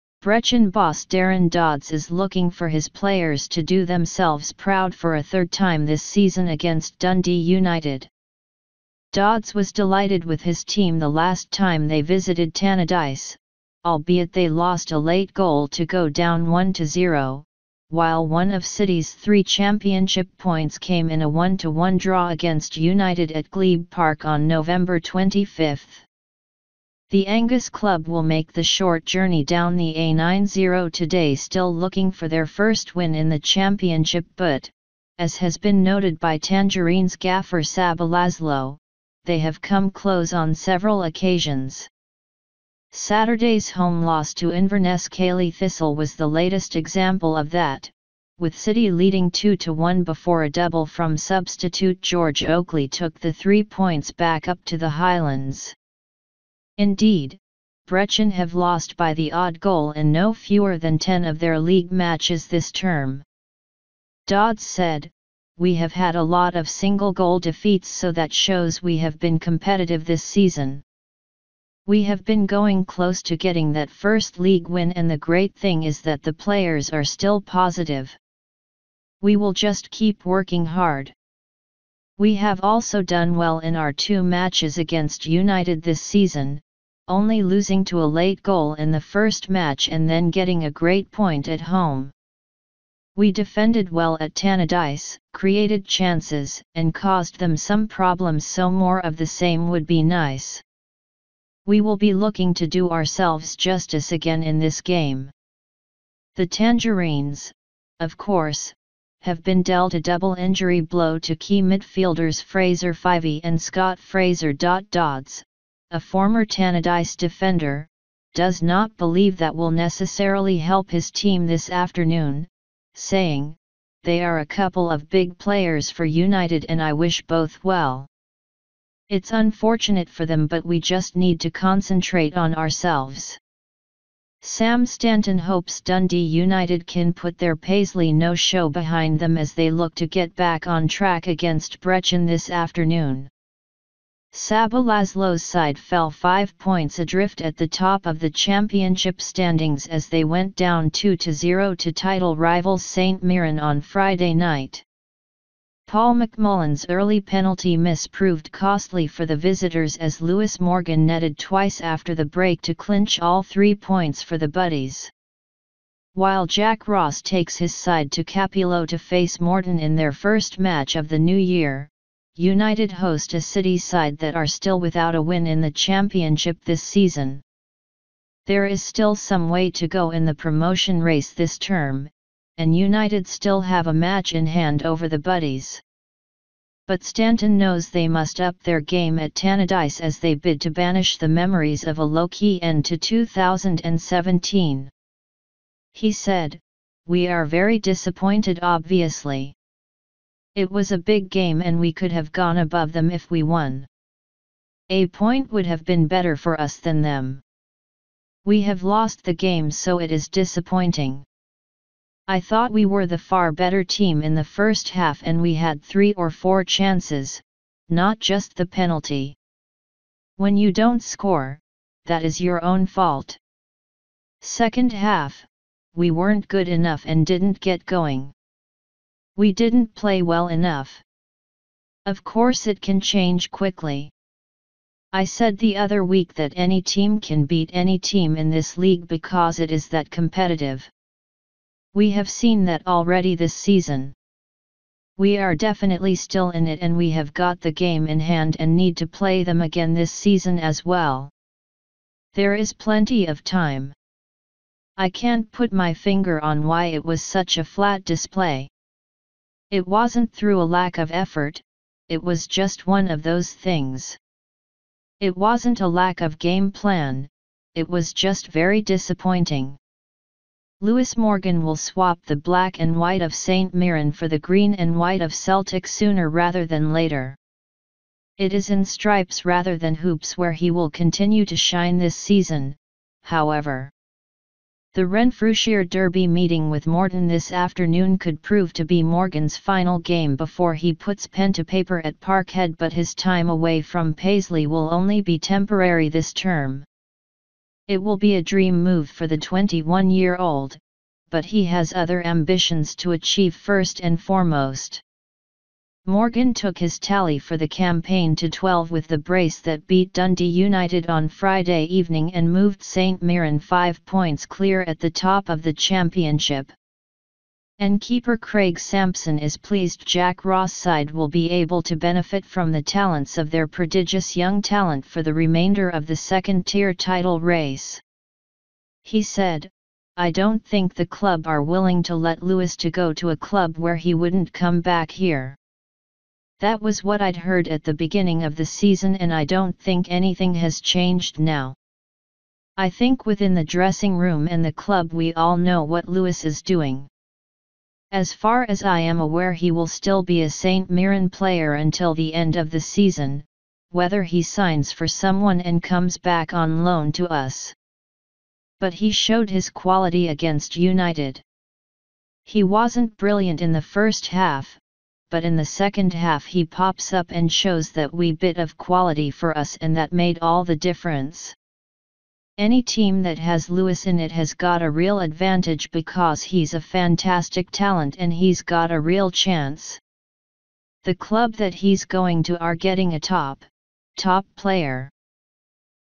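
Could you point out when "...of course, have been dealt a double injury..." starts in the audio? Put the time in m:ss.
1:47.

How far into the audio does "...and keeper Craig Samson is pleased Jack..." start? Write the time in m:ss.
5:17.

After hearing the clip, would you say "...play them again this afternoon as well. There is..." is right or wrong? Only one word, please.
wrong.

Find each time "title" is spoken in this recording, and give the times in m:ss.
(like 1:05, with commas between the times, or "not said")
2:31, 5:26.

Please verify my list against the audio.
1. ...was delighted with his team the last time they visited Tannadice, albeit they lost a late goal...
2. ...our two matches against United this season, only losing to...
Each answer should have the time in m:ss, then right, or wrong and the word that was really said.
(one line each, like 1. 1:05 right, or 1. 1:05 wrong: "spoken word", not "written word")
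1. 0:09 right
2. 1:23 right.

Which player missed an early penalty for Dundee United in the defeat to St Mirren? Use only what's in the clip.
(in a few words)
Paul McMullen.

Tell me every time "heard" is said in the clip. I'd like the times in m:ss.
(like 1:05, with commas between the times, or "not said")
5:37.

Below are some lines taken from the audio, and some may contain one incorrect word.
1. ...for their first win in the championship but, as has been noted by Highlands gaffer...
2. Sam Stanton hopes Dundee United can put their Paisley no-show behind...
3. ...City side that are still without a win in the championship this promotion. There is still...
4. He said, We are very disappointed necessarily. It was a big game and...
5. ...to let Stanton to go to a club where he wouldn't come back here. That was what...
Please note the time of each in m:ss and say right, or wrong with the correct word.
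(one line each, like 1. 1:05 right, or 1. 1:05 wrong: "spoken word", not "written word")
1. 0:32 wrong: "Tangerines", not "Highlands"
2. 2:14 right
3. 2:53 wrong: "season", not "promotion"
4. 3:15 wrong: "obviously", not "necessarily"
5. 5:32 wrong: "Lewis", not "Stanton".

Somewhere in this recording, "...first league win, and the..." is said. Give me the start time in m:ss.
1:13.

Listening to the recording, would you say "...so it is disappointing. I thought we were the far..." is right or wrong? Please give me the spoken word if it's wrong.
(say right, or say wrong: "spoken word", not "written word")
right.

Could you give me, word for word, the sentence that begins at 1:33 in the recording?
We defended well at Tannadice, created chances, and caused them some problems so more of the same would be nice.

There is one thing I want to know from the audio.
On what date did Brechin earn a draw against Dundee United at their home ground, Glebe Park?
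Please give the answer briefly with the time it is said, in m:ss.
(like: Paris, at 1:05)
November 25, at 0:24.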